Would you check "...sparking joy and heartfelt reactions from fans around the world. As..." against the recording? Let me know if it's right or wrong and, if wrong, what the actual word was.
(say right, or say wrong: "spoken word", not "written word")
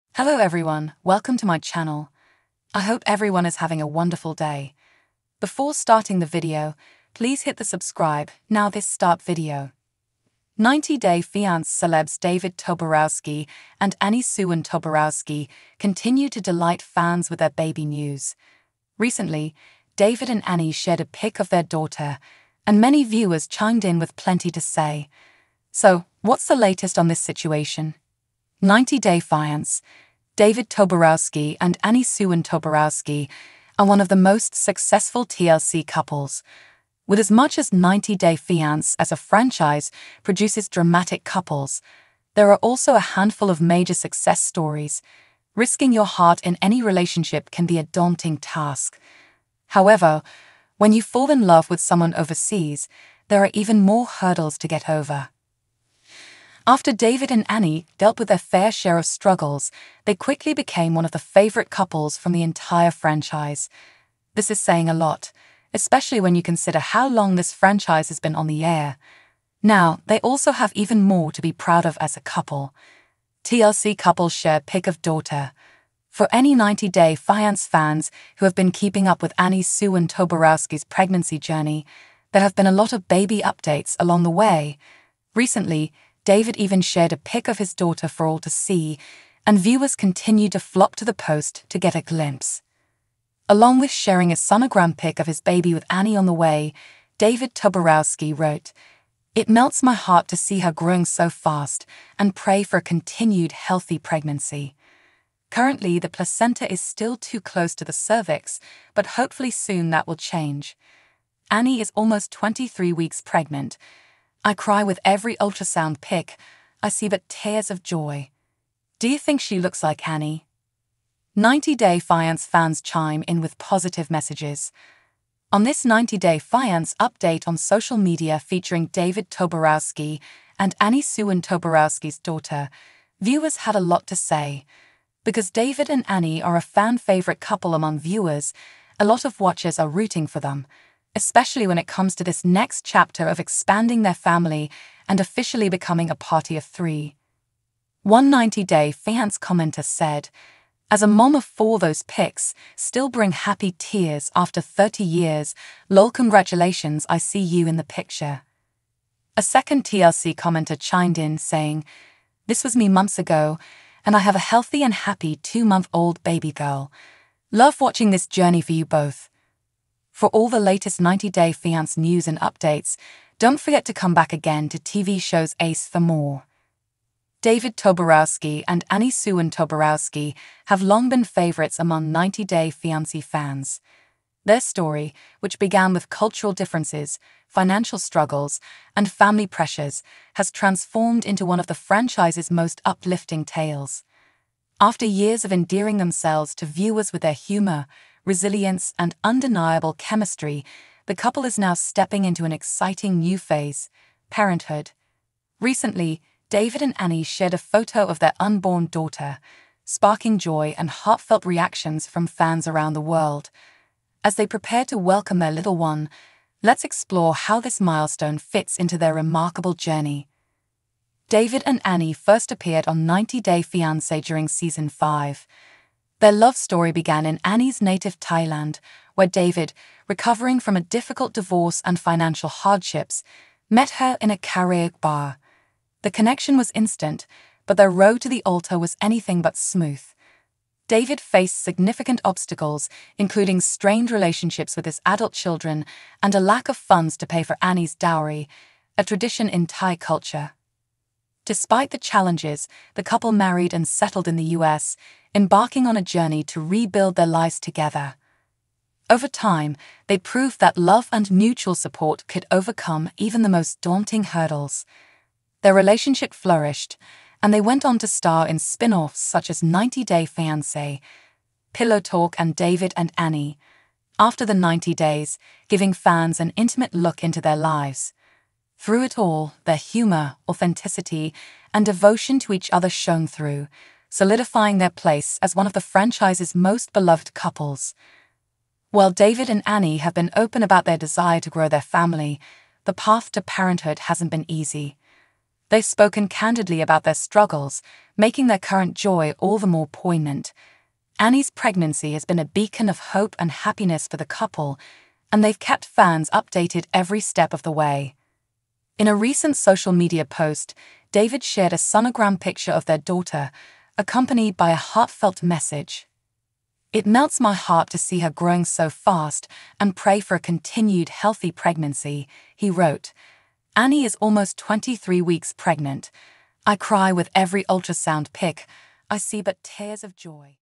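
right.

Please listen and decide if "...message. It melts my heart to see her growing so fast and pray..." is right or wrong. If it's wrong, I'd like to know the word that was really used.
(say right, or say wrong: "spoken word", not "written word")
right.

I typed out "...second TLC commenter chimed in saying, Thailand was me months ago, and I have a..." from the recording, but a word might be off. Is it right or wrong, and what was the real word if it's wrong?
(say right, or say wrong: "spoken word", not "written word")
wrong: "This", not "Thailand".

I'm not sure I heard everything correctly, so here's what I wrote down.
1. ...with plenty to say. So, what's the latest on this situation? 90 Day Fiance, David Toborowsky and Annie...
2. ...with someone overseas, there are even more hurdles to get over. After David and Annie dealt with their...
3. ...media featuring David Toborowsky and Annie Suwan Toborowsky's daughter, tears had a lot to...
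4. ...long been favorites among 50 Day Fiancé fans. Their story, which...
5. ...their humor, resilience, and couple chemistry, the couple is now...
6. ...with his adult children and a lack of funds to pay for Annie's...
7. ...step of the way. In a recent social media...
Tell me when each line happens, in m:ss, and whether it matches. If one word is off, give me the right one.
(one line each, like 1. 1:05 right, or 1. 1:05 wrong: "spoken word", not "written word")
1. 0:23 right
2. 0:51 right
3. 2:07 wrong: "viewers", not "tears"
4. 3:00 wrong: "90", not "50"
5. 3:17 wrong: "undeniable", not "couple"
6. 4:04 right
7. 5:07 right.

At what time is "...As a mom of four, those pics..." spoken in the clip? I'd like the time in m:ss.
2:30.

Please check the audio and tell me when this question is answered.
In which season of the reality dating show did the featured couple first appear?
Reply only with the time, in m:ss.
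3:44.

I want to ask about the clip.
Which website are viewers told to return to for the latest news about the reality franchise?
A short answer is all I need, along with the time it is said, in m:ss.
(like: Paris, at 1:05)
TV Shows Ace, at 2:54.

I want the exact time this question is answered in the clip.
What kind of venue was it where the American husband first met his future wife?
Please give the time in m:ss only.
3:54.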